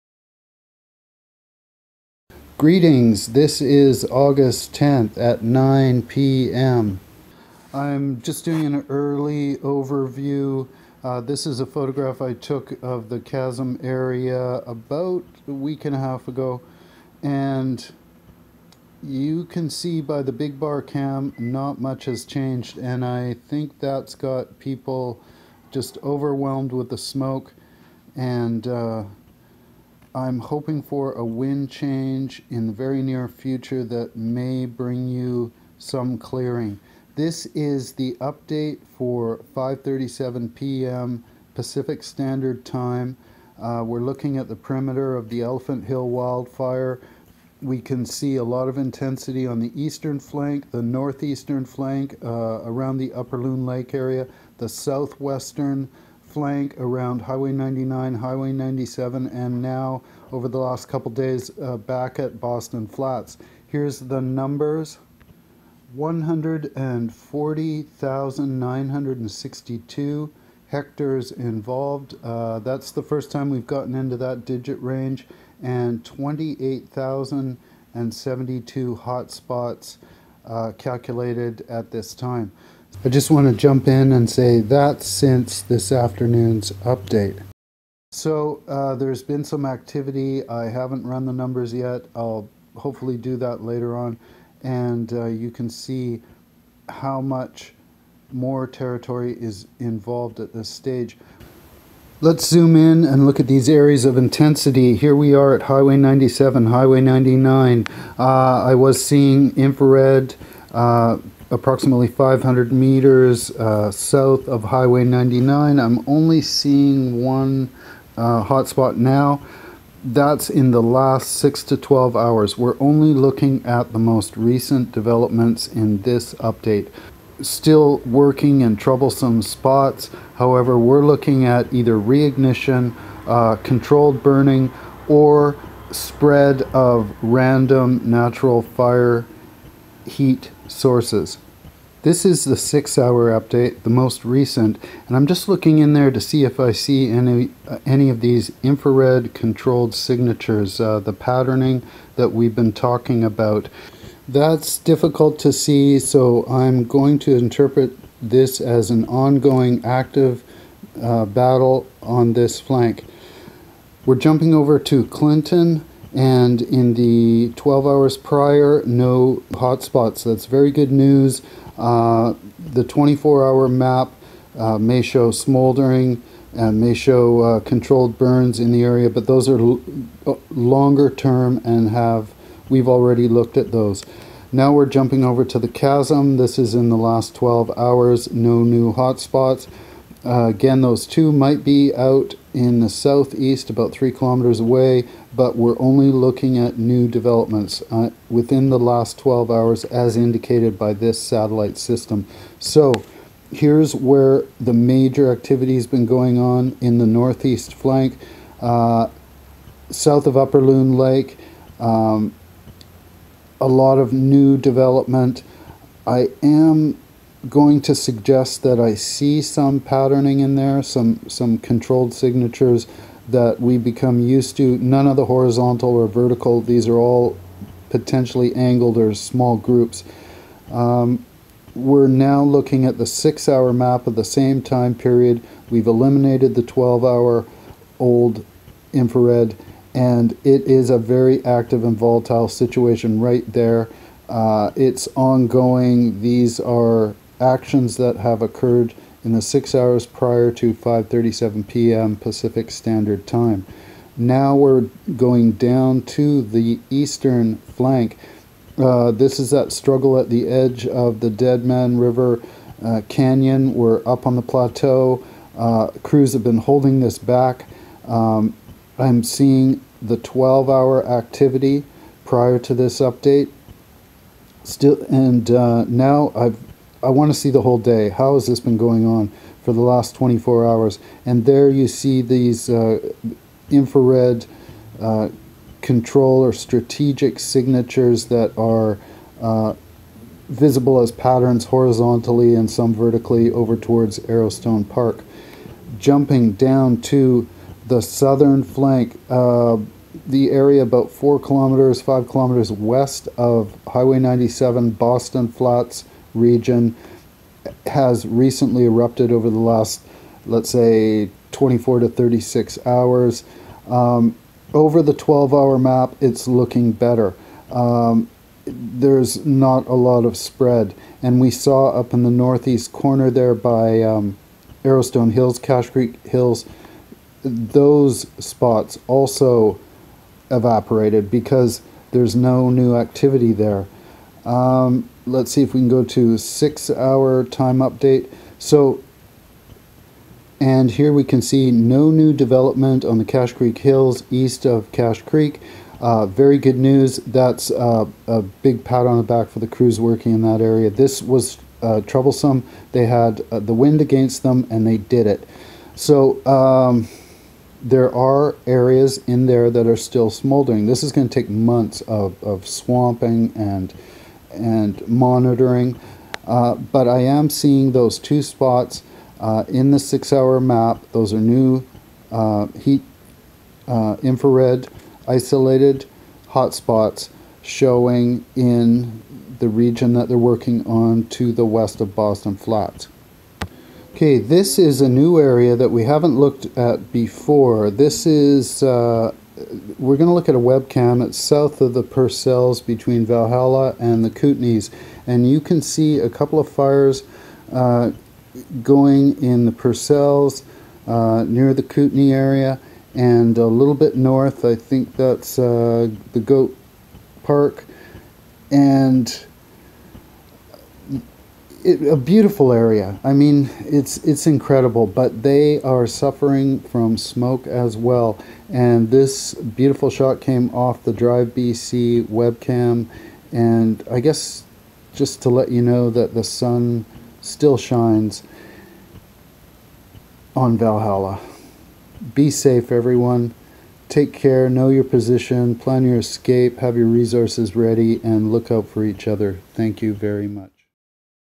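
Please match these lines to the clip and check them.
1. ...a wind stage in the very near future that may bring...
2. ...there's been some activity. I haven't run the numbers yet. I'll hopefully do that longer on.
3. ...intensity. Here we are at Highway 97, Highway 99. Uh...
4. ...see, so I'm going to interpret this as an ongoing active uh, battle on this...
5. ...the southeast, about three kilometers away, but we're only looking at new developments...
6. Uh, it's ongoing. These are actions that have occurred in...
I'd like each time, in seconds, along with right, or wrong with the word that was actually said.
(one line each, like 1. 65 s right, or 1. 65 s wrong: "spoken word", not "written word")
1. 31 s wrong: "change", not "stage"
2. 88 s wrong: "later", not "longer"
3. 104 s right
4. 155 s right
5. 192 s right
6. 244 s right.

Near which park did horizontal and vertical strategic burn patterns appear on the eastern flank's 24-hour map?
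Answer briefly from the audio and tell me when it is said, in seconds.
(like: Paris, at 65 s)
Arrowstone Park, at 294 s.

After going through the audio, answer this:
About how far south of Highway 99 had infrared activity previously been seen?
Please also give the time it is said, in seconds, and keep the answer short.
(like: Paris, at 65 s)
500 meters, at 112 s.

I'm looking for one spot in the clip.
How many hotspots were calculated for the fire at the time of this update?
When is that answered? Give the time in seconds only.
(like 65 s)
76 s.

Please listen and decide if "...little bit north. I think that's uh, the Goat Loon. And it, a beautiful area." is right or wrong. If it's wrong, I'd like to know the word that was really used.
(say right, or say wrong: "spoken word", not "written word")
wrong: "Park", not "Loon".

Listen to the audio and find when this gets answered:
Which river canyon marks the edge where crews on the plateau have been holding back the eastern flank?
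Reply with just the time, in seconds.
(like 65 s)
261 s.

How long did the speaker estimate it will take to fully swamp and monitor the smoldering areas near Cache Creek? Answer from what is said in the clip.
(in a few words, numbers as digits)
months.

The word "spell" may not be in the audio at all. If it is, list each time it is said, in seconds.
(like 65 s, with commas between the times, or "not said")
not said.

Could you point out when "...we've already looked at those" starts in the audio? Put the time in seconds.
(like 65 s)
182 s.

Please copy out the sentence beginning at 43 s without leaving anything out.
Uh, we're looking at the perimeter of the Elephant Hill wildfire.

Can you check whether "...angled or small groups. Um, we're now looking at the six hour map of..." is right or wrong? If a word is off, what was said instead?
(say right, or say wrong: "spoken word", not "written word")
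right.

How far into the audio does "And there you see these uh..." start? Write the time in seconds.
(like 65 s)
281 s.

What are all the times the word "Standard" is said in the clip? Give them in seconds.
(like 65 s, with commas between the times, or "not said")
42 s, 252 s.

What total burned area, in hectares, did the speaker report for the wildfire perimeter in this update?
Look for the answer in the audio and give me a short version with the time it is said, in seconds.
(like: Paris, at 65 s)
140,962 hectares, at 65 s.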